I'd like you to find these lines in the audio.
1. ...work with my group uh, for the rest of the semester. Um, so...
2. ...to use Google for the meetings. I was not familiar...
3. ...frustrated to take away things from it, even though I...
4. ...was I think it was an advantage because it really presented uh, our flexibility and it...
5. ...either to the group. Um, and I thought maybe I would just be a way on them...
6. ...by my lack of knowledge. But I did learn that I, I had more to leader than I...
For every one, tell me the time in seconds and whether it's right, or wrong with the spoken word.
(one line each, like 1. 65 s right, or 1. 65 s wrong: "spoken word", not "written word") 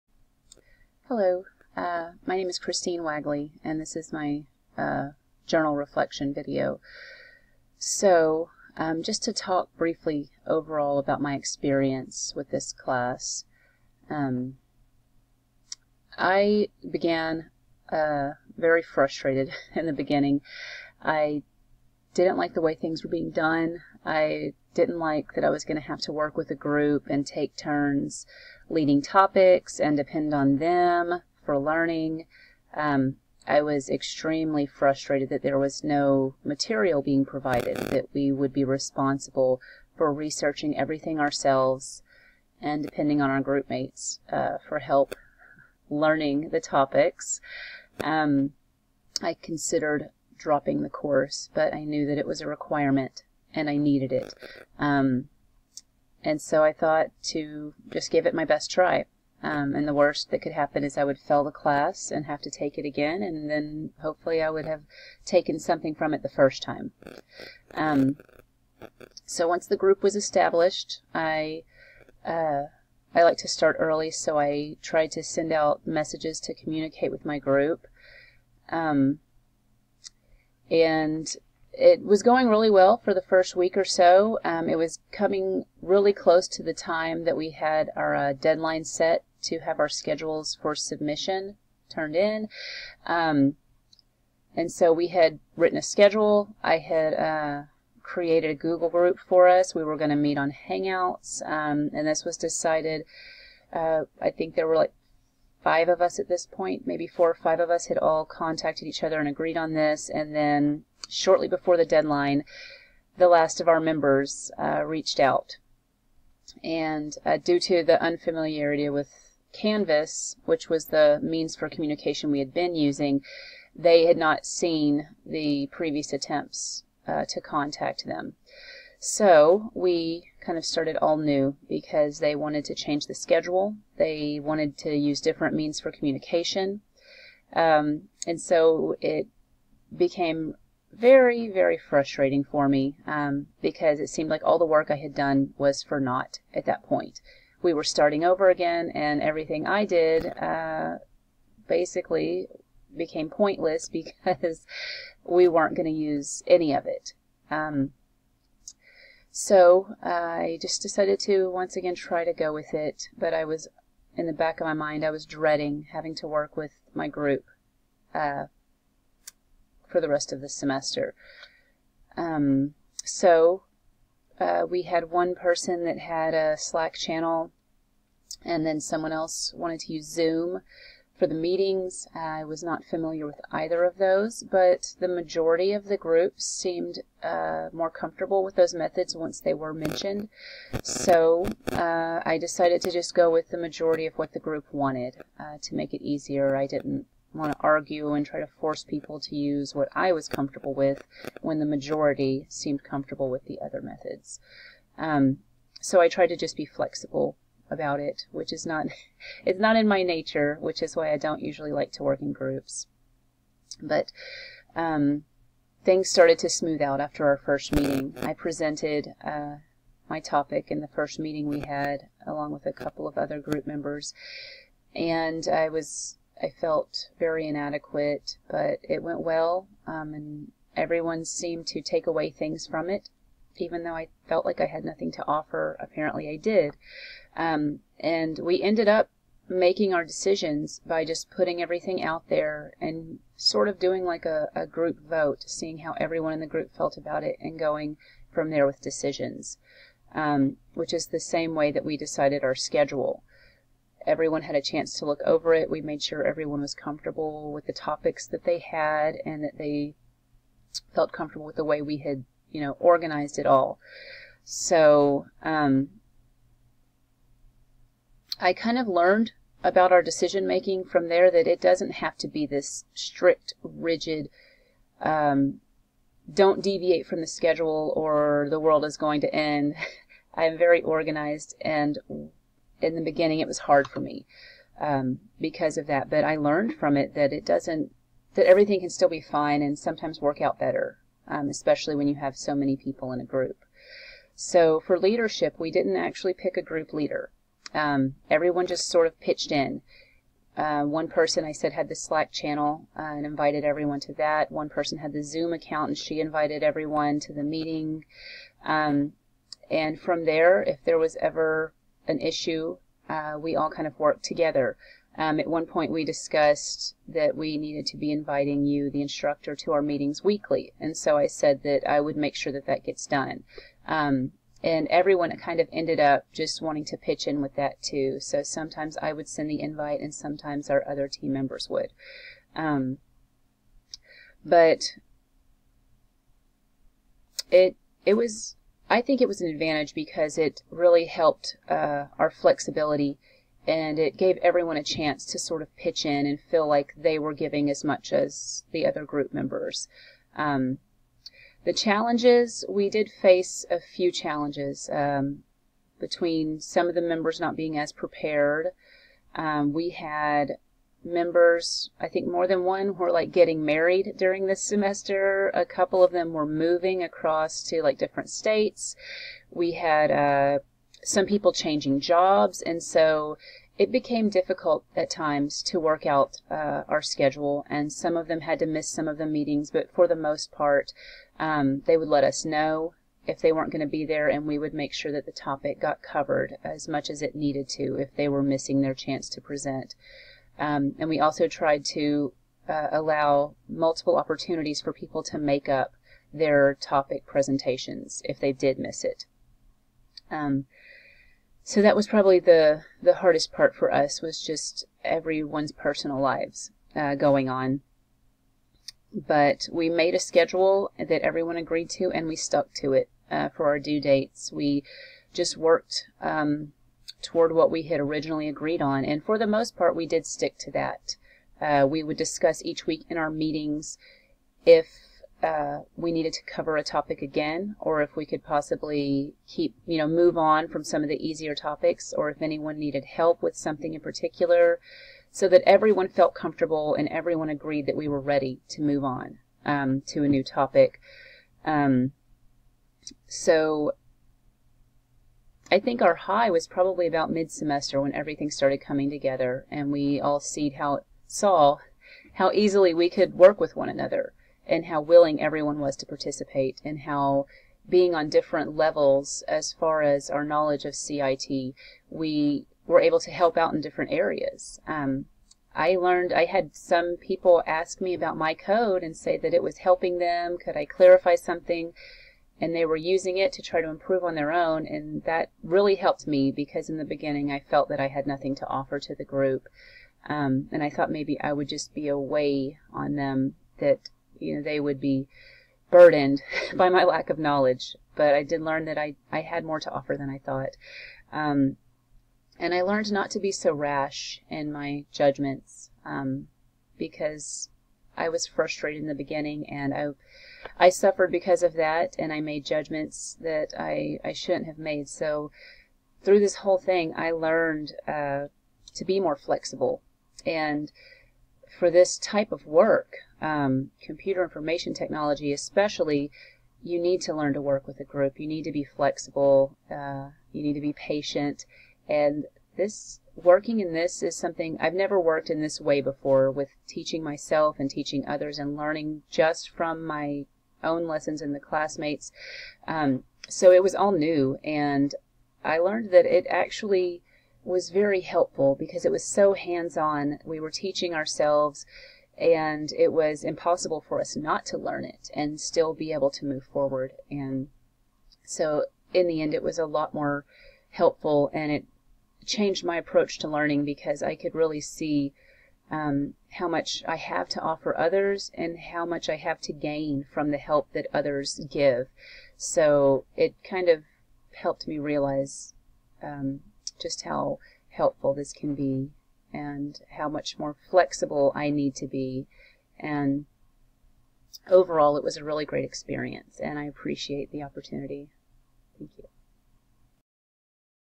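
1. 166 s right
2. 179 s wrong: "Zoom", not "Google"
3. 231 s wrong: "seemed", not "frustrated"
4. 338 s wrong: "helped", not "presented"
5. 478 s wrong: "offer", not "either"
6. 486 s wrong: "offer", not "leader".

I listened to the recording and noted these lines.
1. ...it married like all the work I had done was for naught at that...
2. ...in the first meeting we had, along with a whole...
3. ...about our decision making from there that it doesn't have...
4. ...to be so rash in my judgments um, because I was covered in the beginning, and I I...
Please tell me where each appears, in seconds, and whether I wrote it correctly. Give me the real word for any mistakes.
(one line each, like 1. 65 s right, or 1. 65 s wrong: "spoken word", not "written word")
1. 143 s wrong: "seemed", not "married"
2. 220 s wrong: "couple", not "whole"
3. 269 s right
4. 493 s wrong: "frustrated", not "covered".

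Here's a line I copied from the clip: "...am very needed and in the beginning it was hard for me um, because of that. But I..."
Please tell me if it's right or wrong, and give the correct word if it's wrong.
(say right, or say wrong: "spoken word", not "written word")
wrong: "organized", not "needed".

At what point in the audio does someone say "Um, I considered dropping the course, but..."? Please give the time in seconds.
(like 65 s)
48 s.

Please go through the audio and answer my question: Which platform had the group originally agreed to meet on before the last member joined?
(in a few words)
Hangouts.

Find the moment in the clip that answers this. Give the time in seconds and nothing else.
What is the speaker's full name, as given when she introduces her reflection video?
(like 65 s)
2 s.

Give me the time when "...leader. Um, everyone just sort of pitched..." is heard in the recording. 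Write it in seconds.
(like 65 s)
296 s.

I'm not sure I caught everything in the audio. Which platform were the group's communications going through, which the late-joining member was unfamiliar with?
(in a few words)
Canvas.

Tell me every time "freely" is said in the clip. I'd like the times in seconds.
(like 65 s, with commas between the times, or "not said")
not said.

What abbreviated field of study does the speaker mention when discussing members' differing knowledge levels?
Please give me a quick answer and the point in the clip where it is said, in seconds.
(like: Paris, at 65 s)
CIT, at 460 s.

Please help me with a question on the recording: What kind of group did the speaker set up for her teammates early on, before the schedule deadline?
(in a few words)
Google group.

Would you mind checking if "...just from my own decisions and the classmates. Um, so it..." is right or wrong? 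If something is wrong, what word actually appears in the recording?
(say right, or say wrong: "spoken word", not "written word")
wrong: "lessons", not "decisions".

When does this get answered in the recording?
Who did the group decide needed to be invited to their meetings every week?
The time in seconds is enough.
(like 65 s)
318 s.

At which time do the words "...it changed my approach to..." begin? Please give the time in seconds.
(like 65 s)
551 s.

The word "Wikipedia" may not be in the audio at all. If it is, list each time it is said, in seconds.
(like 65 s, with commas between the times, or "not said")
not said.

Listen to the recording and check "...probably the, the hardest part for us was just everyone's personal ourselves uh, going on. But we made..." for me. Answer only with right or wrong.
wrong.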